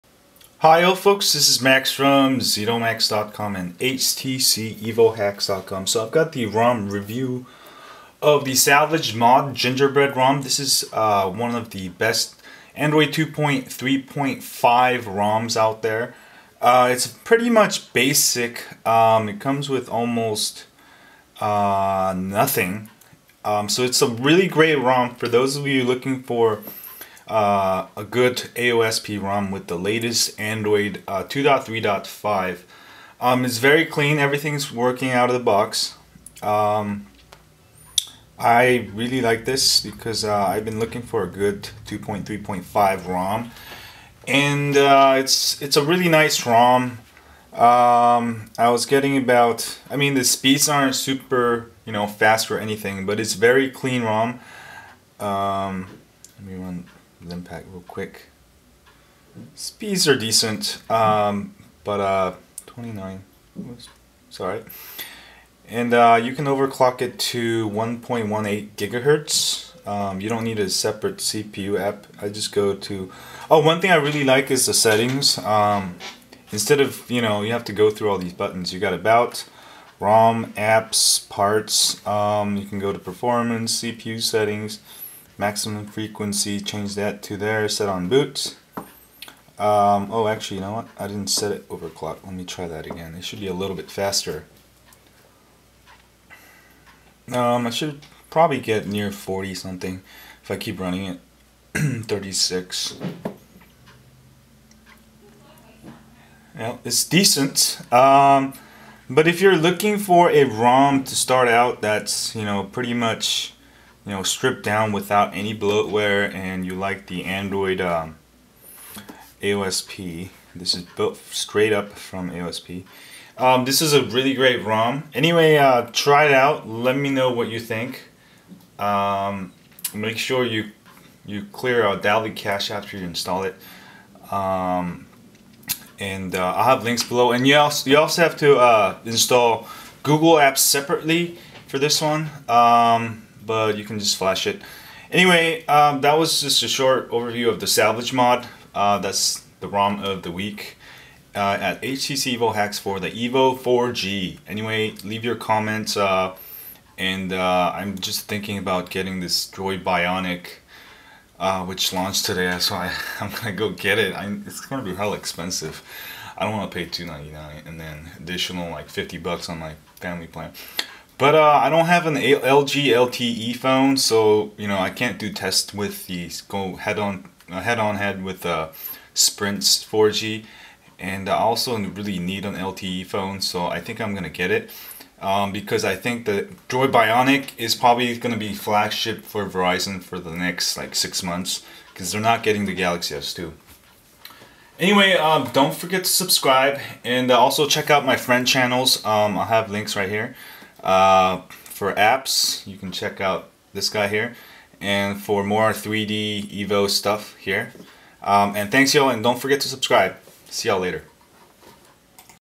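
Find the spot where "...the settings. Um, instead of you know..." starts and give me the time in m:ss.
1:14.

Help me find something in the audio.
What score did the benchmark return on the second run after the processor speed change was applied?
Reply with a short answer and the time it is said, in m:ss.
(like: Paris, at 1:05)
36, at 1:42.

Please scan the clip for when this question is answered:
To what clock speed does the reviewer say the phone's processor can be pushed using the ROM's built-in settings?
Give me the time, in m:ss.
1:07.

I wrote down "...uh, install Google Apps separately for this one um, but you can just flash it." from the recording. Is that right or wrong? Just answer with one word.
right.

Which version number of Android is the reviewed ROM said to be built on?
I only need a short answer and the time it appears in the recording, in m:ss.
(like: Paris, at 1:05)
2.3.5, at 0:12.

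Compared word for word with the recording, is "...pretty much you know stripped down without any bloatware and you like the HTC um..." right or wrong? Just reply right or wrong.
wrong.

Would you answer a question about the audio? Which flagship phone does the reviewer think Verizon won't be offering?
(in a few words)
Galaxy S2.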